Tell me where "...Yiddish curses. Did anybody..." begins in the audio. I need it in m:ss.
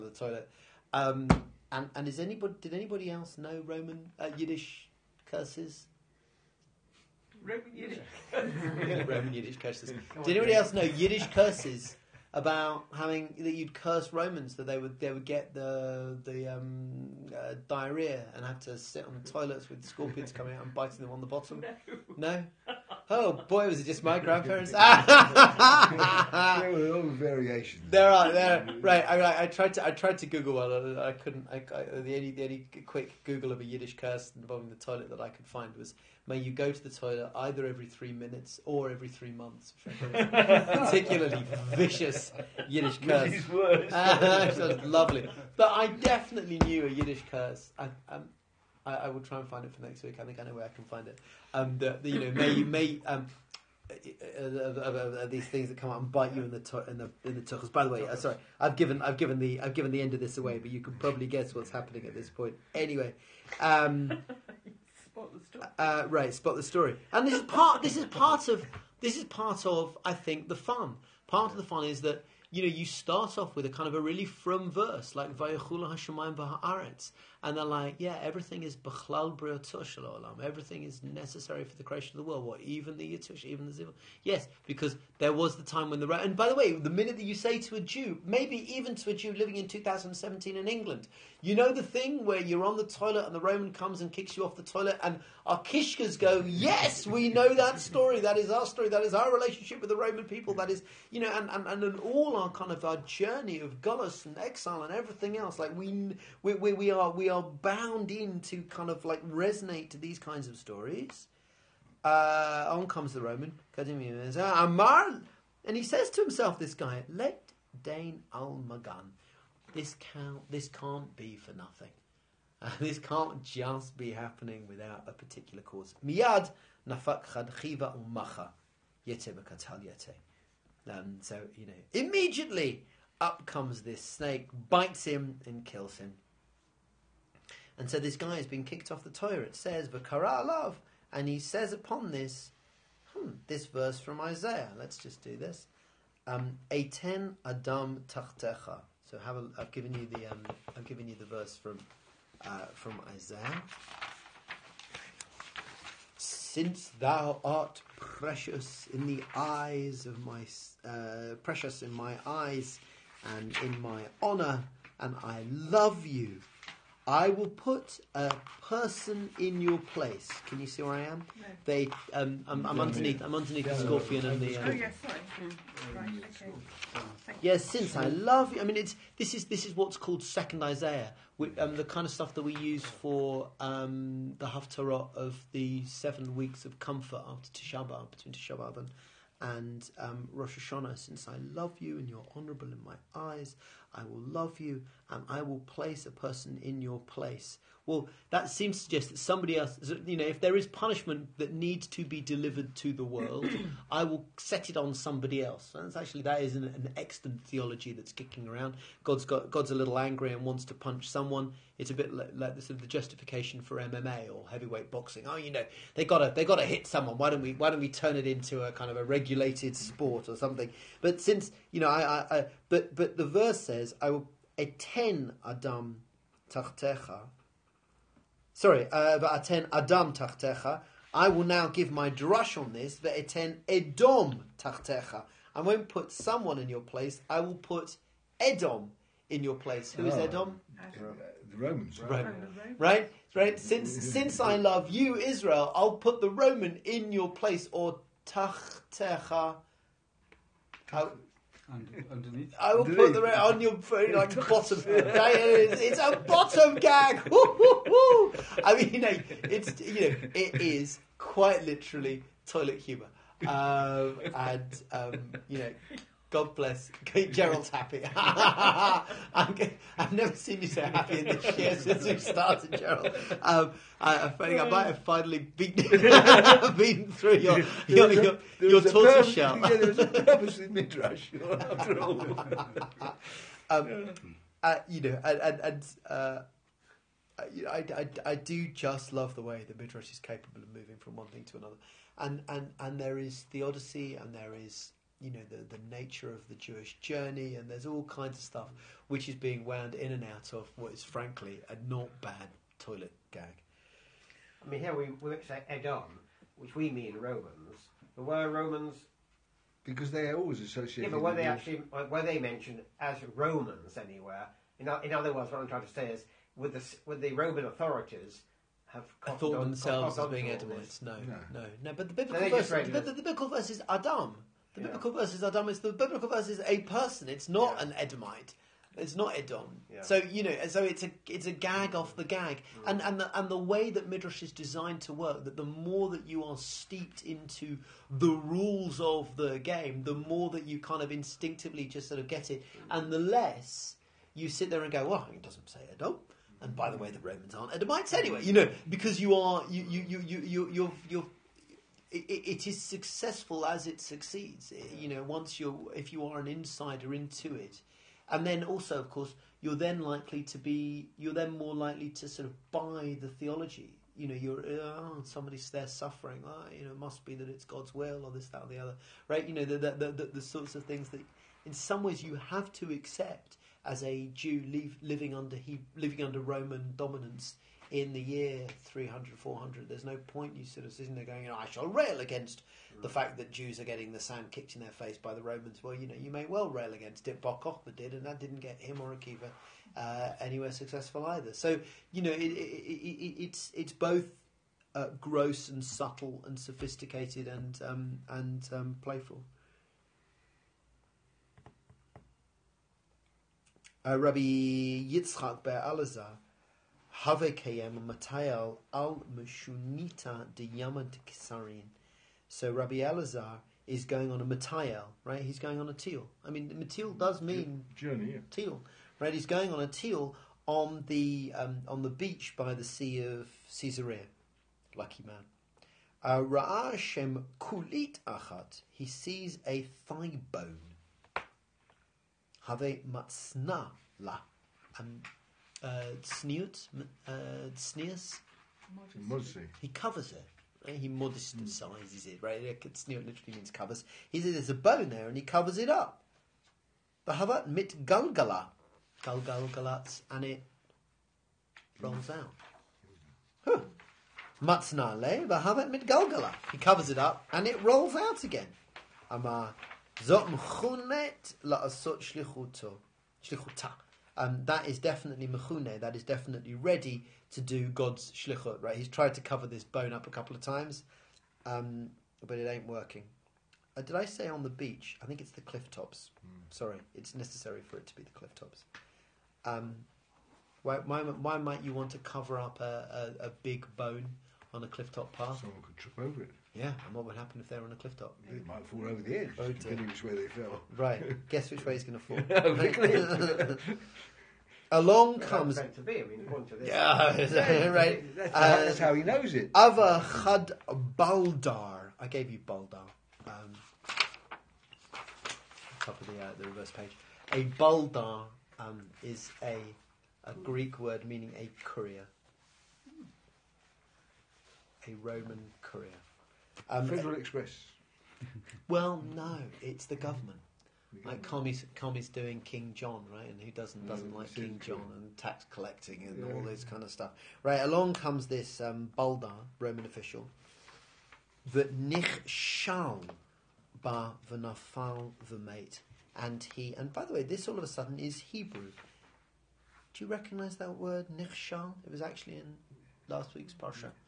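0:09.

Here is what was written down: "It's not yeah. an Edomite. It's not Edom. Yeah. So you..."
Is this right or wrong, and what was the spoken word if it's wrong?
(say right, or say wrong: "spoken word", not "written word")
right.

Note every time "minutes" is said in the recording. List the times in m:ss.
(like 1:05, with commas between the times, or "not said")
0:38, 1:26.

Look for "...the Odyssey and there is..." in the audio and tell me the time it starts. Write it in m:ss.
4:53.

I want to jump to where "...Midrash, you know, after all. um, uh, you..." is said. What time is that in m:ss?
4:40.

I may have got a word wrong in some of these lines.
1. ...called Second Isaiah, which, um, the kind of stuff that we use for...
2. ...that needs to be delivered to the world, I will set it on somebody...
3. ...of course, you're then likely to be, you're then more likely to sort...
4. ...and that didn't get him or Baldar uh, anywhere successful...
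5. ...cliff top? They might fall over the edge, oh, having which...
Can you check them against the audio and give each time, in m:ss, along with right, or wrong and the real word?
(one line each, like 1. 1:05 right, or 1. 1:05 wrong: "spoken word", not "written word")
1. 2:59 right
2. 3:21 right
3. 5:58 right
4. 6:28 wrong: "Akiva", not "Baldar"
5. 8:07 wrong: "depending", not "having".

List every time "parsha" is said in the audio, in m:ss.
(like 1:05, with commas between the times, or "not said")
9:03.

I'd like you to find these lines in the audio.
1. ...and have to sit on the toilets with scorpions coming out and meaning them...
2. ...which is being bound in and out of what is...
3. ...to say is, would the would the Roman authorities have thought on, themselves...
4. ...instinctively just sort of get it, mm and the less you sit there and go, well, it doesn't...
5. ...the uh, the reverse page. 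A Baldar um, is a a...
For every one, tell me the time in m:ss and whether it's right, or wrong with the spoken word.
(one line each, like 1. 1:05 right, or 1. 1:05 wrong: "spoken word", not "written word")
1. 0:18 wrong: "biting", not "meaning"
2. 4:59 wrong: "wound", not "bound"
3. 5:15 right
4. 5:41 right
5. 8:26 right.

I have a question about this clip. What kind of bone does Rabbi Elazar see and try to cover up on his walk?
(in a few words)
a thigh bone.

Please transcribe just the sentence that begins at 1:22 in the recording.
What, even the yitush, even the zivul?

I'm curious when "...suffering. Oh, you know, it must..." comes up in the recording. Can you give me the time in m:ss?
6:05.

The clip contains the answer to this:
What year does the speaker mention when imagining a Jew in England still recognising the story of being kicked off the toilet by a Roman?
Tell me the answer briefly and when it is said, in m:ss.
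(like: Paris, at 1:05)
2017, at 1:29.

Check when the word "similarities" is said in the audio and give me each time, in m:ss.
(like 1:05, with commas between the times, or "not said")
not said.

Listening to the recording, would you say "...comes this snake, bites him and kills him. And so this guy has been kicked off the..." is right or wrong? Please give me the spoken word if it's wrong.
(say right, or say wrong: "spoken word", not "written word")
right.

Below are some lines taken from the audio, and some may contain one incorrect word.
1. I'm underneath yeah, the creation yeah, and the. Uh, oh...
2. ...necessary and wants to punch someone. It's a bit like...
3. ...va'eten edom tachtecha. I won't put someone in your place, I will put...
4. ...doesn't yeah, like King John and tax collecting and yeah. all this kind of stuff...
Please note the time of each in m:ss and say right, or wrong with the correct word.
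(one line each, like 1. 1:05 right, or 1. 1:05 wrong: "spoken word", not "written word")
1. 2:53 wrong: "scorpion", not "creation"
2. 3:29 wrong: "angry", not "necessary"
3. 3:52 right
4. 8:44 right.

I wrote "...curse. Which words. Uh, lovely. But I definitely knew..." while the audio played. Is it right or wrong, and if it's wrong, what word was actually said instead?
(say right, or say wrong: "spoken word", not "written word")
right.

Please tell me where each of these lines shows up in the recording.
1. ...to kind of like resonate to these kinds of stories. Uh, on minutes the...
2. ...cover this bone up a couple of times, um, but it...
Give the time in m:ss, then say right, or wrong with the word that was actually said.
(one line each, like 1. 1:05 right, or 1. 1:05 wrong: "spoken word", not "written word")
1. 1:48 wrong: "comes", not "minutes"
2. 7:49 right.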